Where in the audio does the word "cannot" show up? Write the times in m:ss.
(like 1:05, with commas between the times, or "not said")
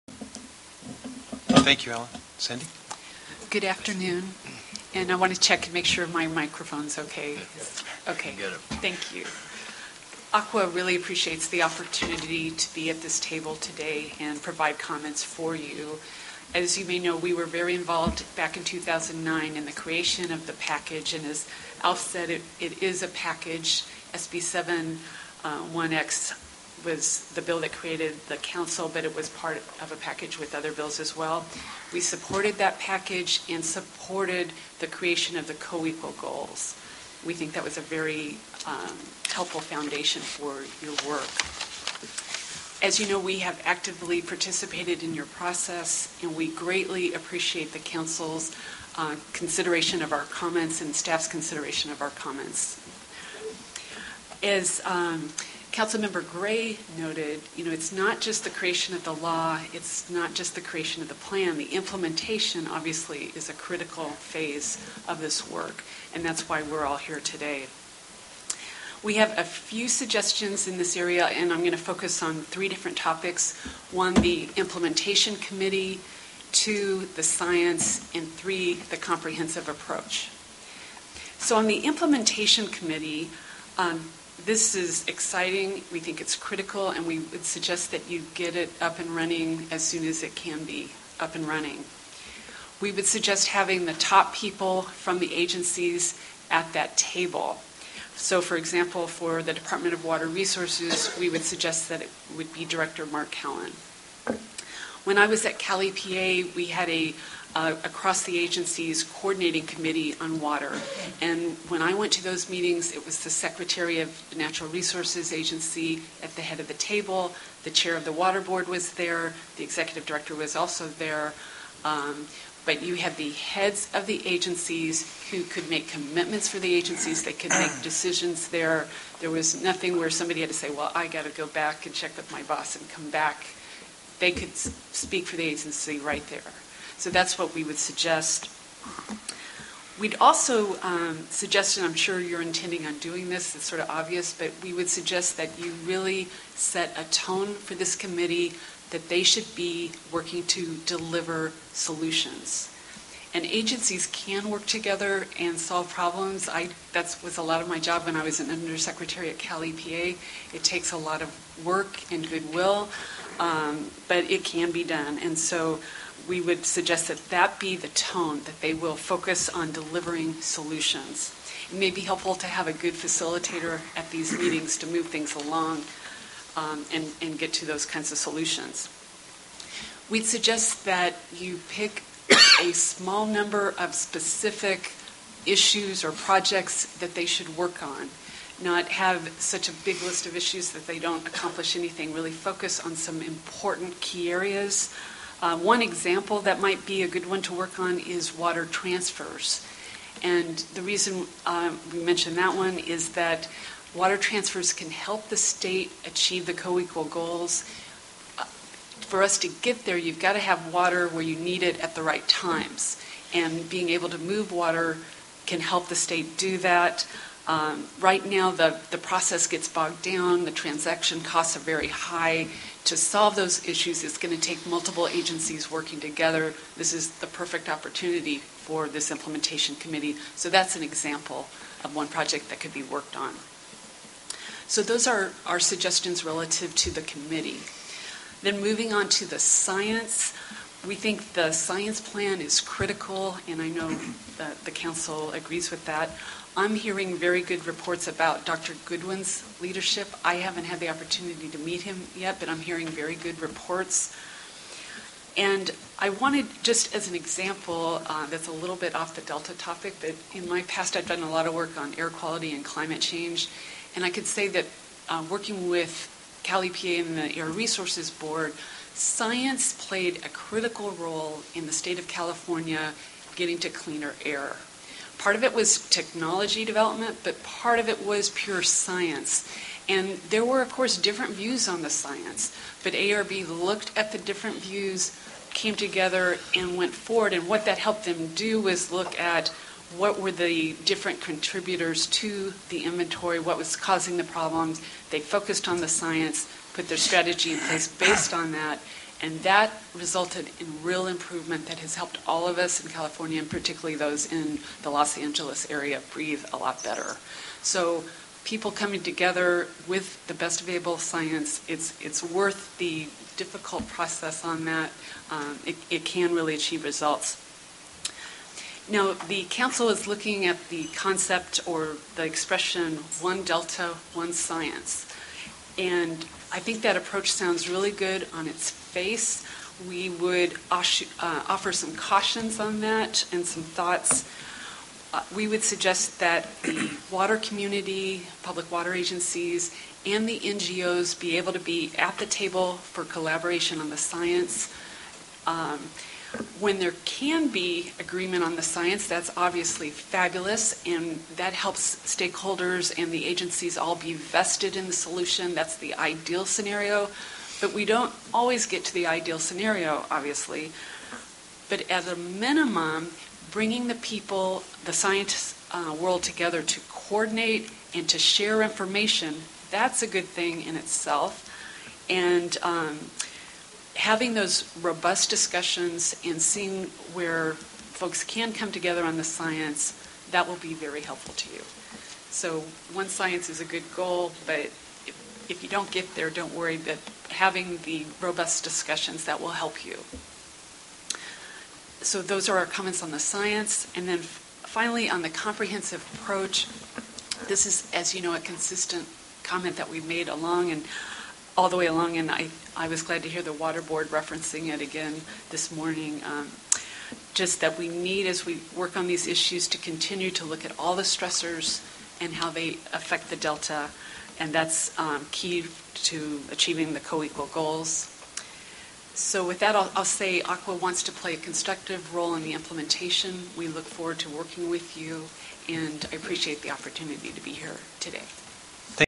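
not said.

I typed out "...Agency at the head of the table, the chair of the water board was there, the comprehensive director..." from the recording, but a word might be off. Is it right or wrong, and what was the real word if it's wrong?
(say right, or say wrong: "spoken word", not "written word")
wrong: "executive", not "comprehensive".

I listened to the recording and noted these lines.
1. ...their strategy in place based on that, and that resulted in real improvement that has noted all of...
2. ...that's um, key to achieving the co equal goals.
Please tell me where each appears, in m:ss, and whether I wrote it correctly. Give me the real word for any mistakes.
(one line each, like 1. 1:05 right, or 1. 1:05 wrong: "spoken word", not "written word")
1. 4:56 wrong: "helped", not "noted"
2. 6:54 right.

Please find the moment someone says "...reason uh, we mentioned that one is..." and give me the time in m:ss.
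3:20.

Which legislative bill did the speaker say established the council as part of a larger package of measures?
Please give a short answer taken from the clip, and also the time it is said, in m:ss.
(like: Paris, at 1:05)
SB 71x, at 0:24.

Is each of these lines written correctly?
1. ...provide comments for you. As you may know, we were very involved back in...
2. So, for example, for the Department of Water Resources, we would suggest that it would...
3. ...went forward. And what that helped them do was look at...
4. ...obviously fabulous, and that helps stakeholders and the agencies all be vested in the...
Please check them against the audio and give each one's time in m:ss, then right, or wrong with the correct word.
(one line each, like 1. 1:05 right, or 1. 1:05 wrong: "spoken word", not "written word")
1. 0:14 right
2. 1:38 right
3. 4:46 right
4. 5:49 right.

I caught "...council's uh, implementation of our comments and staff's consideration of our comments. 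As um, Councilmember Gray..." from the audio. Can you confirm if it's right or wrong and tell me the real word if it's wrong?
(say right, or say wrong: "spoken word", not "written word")
wrong: "consideration", not "implementation".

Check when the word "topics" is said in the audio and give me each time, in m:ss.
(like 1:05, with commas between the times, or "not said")
1:12, 4:19.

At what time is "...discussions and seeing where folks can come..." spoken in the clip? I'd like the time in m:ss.
6:15.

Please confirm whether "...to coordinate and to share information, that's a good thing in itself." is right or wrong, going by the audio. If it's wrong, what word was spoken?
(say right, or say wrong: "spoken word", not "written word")
right.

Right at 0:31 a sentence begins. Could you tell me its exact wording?
We supported that package and supported the creation of the co-equal goals.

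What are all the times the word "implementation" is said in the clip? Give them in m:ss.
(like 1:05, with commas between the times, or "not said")
1:01, 1:14, 1:21, 3:49, 7:02.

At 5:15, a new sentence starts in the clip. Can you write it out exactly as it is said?
Um, it, it can really achieve results.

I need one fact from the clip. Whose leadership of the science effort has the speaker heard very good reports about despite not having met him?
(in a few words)
Dr. Goodwin.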